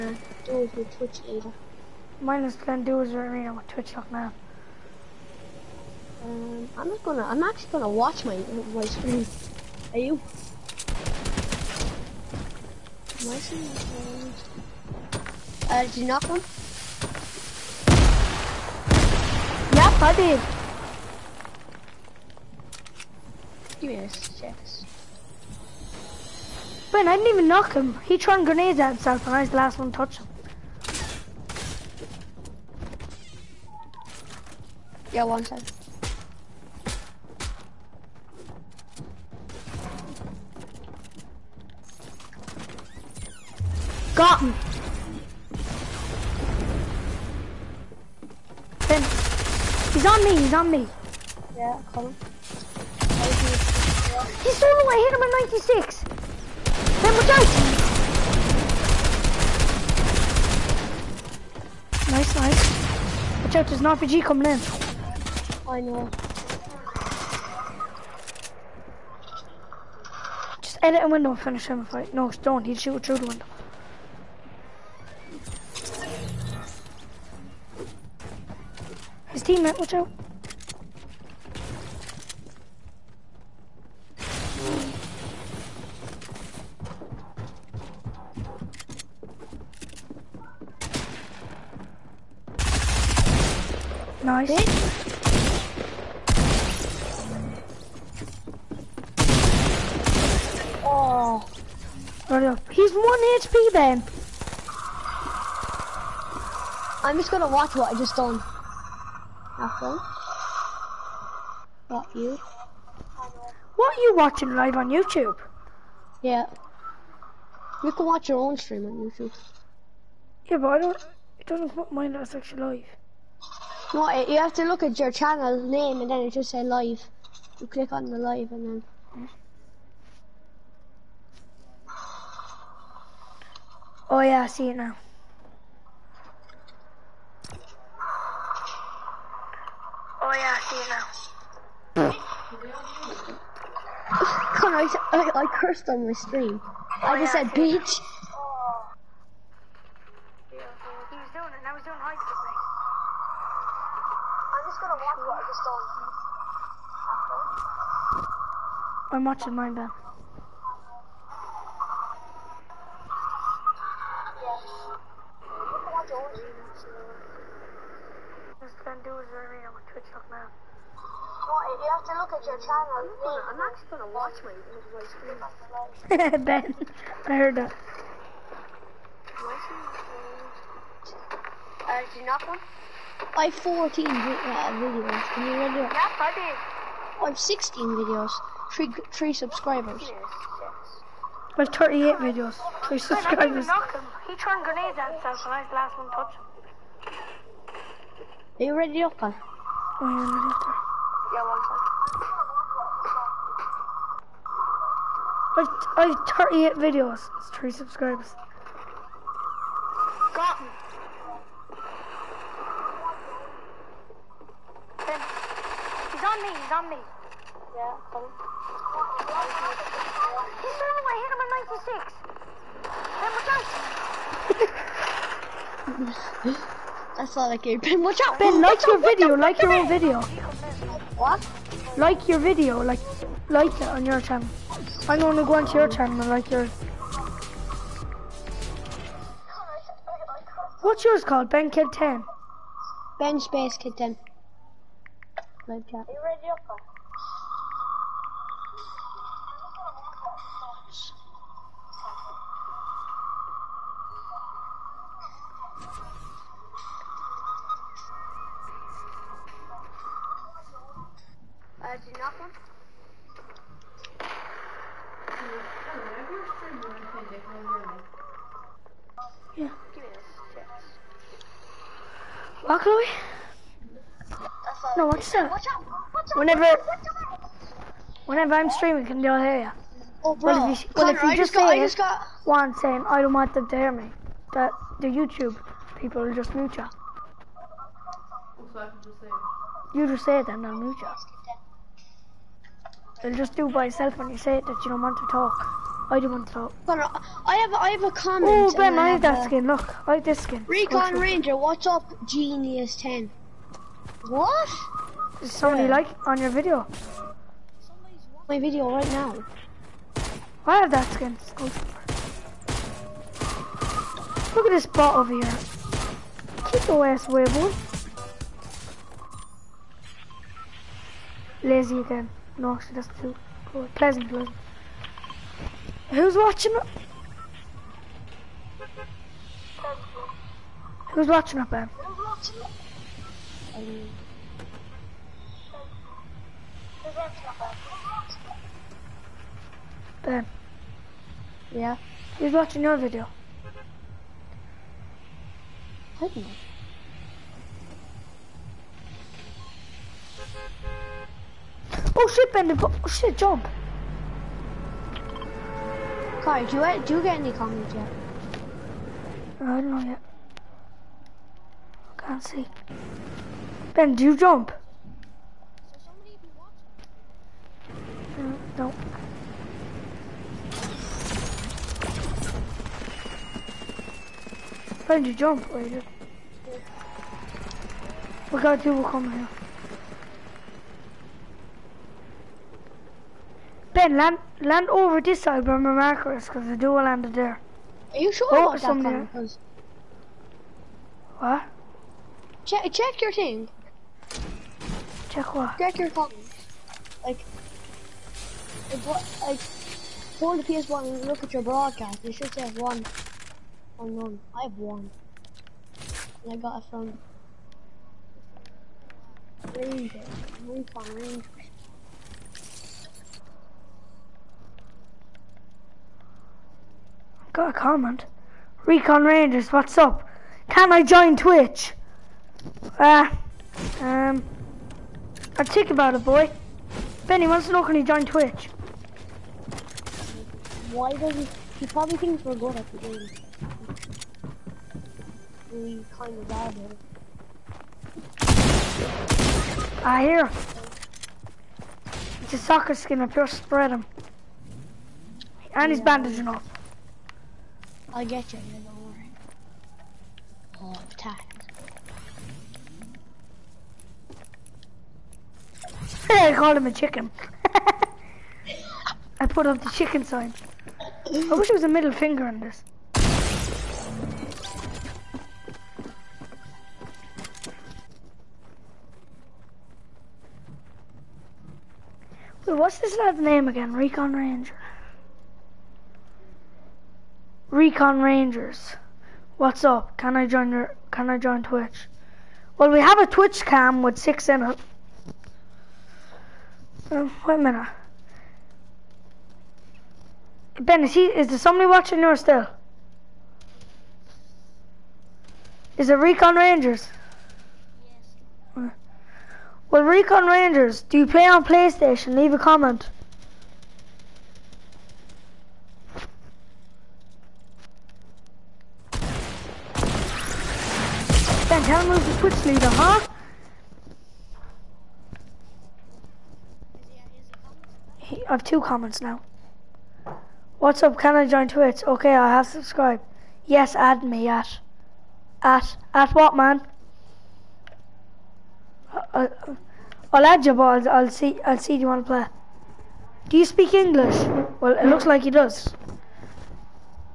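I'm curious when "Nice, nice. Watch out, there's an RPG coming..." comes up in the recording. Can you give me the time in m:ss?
1:02.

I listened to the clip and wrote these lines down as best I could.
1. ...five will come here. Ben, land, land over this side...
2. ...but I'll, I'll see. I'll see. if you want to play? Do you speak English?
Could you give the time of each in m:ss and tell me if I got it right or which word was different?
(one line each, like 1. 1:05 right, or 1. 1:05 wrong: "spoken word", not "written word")
1. 6:18 wrong: "two", not "five"
2. 8:50 right.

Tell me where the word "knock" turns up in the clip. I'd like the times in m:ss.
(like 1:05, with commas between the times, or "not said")
0:16, 0:27, 3:02.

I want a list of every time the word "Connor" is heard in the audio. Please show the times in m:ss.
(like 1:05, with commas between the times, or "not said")
2:24, 4:41, 4:56.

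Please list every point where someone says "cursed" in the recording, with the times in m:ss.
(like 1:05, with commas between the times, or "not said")
2:25.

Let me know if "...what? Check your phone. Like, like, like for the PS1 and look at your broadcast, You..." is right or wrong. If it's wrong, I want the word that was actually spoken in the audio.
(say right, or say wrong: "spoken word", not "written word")
right.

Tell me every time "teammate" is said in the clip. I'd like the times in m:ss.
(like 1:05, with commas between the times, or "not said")
1:19.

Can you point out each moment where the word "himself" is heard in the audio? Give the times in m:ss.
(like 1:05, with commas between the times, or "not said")
0:28, 3:15.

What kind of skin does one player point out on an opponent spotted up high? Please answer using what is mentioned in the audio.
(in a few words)
Soccer skin.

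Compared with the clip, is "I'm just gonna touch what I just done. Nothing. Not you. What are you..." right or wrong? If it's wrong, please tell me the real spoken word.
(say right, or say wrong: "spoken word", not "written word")
wrong: "watch", not "touch".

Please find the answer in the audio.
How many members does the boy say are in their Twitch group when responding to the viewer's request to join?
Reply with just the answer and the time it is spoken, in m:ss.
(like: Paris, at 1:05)
6, at 8:04.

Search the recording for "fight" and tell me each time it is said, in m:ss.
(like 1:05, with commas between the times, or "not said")
1:11.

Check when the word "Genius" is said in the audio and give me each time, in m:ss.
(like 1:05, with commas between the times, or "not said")
5:02.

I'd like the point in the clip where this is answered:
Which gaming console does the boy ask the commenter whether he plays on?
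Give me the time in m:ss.
8:21.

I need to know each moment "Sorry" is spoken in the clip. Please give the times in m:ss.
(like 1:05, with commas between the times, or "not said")
5:56.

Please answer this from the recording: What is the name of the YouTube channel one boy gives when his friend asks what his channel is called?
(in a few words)
Ben Space Kid 10.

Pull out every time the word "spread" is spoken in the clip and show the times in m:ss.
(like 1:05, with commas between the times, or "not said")
7:23.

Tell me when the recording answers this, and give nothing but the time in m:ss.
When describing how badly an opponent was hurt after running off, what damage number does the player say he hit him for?
0:55.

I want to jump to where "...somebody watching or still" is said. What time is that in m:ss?
8:11.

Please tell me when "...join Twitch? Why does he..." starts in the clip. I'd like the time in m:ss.
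7:08.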